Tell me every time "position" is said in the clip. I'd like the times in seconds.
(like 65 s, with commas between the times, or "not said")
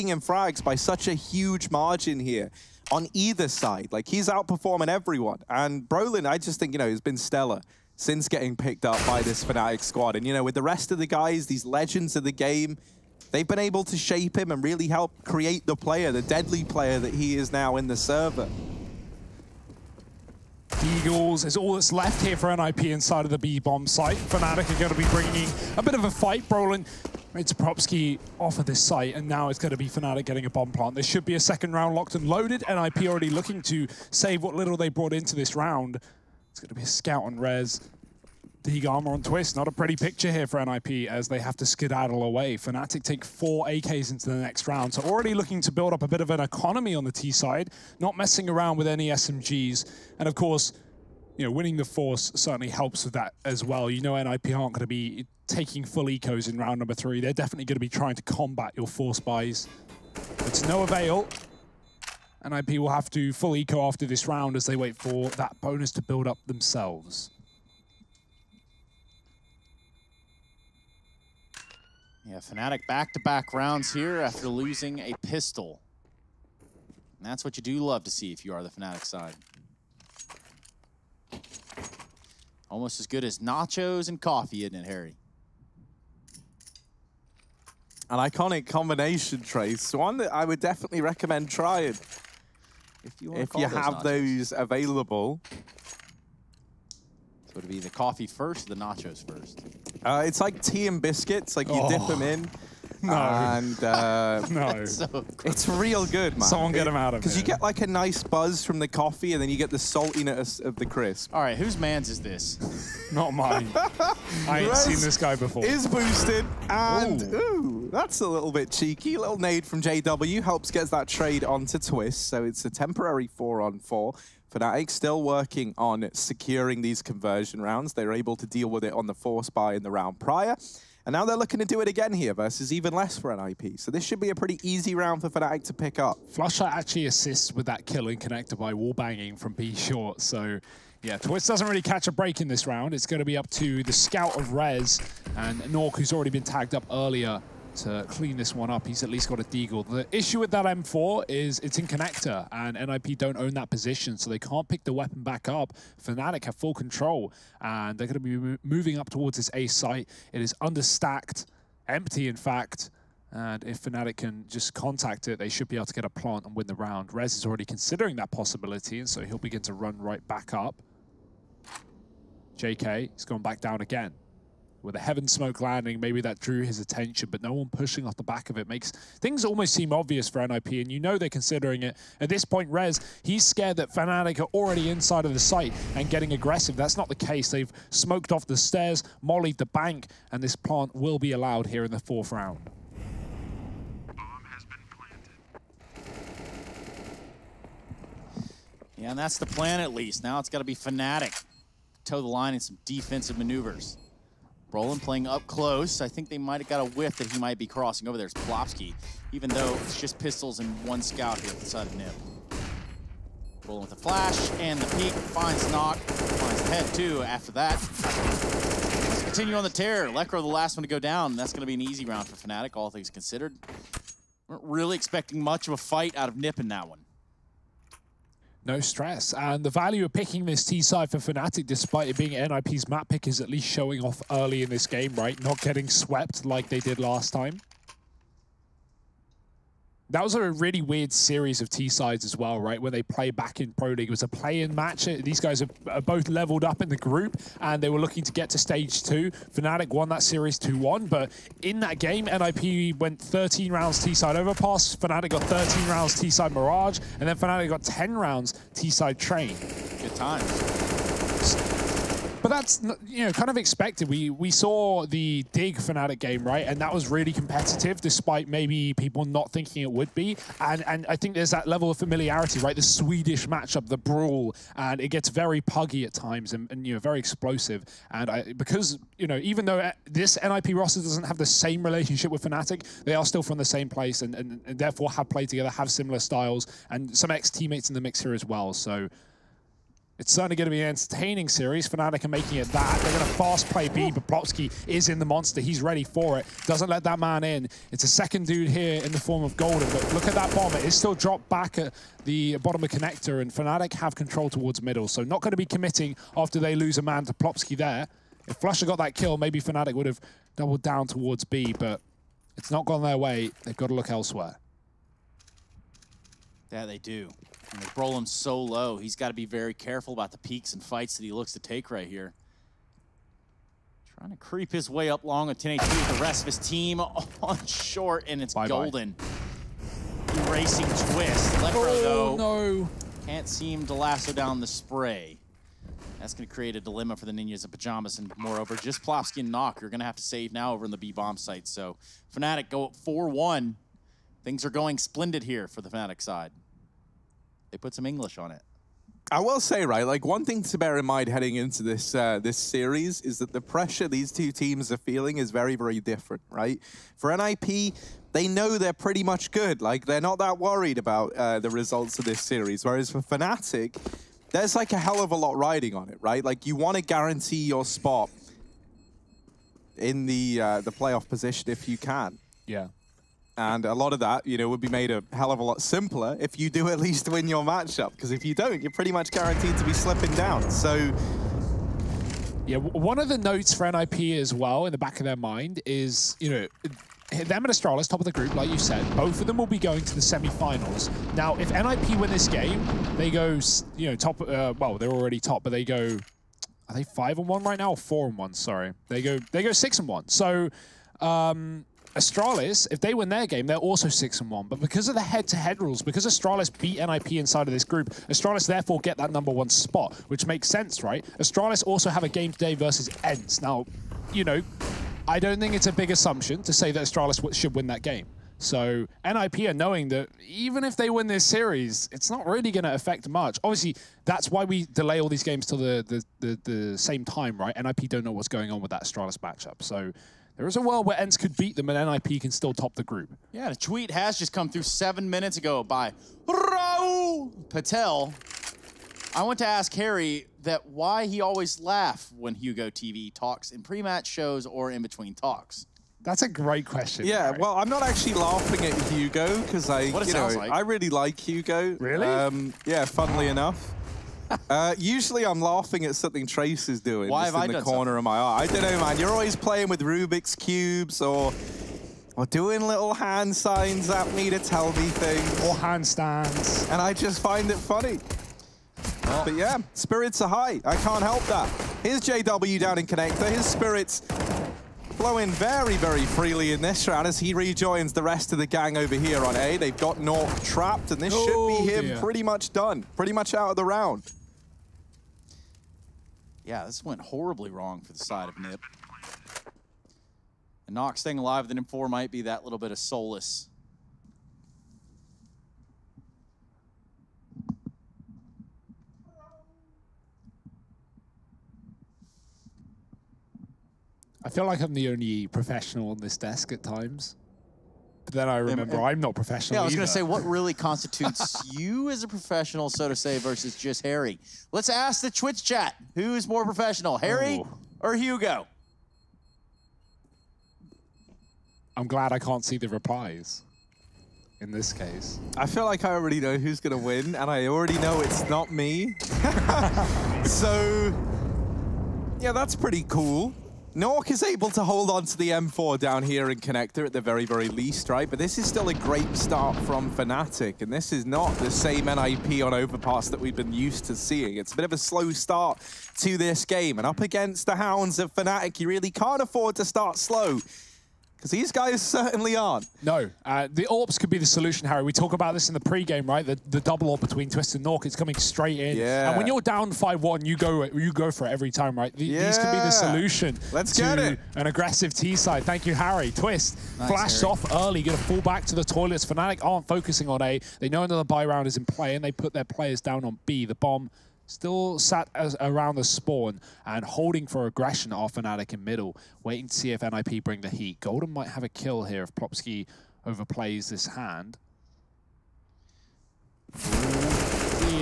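153 s, 371 s.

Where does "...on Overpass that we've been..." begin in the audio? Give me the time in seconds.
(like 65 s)
542 s.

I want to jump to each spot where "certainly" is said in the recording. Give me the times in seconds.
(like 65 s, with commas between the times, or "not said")
52 s, 290 s, 552 s.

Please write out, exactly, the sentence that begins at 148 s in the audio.
He's at least got a deagle.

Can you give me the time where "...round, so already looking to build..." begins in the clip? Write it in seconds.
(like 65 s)
44 s.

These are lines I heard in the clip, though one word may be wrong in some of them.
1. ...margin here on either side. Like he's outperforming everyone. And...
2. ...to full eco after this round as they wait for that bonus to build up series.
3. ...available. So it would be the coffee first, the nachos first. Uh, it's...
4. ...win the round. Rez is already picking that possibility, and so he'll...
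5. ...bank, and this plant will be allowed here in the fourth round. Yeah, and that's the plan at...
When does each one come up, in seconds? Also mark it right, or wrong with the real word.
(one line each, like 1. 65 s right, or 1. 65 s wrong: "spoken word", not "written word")
1. 1 s right
2. 63 s wrong: "themselves", not "series"
3. 94 s right
4. 166 s wrong: "considering", not "picking"
5. 189 s right.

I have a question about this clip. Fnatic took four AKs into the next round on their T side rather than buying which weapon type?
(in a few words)
SMGs.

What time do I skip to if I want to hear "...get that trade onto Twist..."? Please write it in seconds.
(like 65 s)
120 s.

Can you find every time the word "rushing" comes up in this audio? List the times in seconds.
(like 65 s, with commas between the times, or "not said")
not said.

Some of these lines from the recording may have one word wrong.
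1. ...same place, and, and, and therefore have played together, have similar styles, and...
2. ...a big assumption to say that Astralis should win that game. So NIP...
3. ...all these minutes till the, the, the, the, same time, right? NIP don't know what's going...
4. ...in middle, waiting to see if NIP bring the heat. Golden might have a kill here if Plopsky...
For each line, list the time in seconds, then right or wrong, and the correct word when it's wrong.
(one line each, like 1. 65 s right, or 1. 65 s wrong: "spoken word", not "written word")
1. 283 s right
2. 415 s right
3. 425 s wrong: "games", not "minutes"
4. 578 s right.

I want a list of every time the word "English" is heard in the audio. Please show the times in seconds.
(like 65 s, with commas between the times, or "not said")
348 s.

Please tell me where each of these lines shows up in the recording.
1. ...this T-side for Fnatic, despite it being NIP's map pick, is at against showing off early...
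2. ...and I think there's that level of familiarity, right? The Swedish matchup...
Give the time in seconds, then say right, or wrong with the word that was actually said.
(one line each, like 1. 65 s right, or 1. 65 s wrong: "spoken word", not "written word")
1. 230 s wrong: "least", not "against"
2. 270 s right.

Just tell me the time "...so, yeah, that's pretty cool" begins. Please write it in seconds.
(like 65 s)
530 s.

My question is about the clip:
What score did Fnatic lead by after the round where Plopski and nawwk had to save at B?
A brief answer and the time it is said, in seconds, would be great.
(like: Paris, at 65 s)
4-1, at 342 s.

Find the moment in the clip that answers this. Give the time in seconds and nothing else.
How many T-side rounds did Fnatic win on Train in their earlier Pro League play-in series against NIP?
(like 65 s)
257 s.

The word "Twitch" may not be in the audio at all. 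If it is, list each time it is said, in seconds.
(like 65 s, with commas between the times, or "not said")
141 s, 515 s.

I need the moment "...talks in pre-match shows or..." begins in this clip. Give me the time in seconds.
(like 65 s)
443 s.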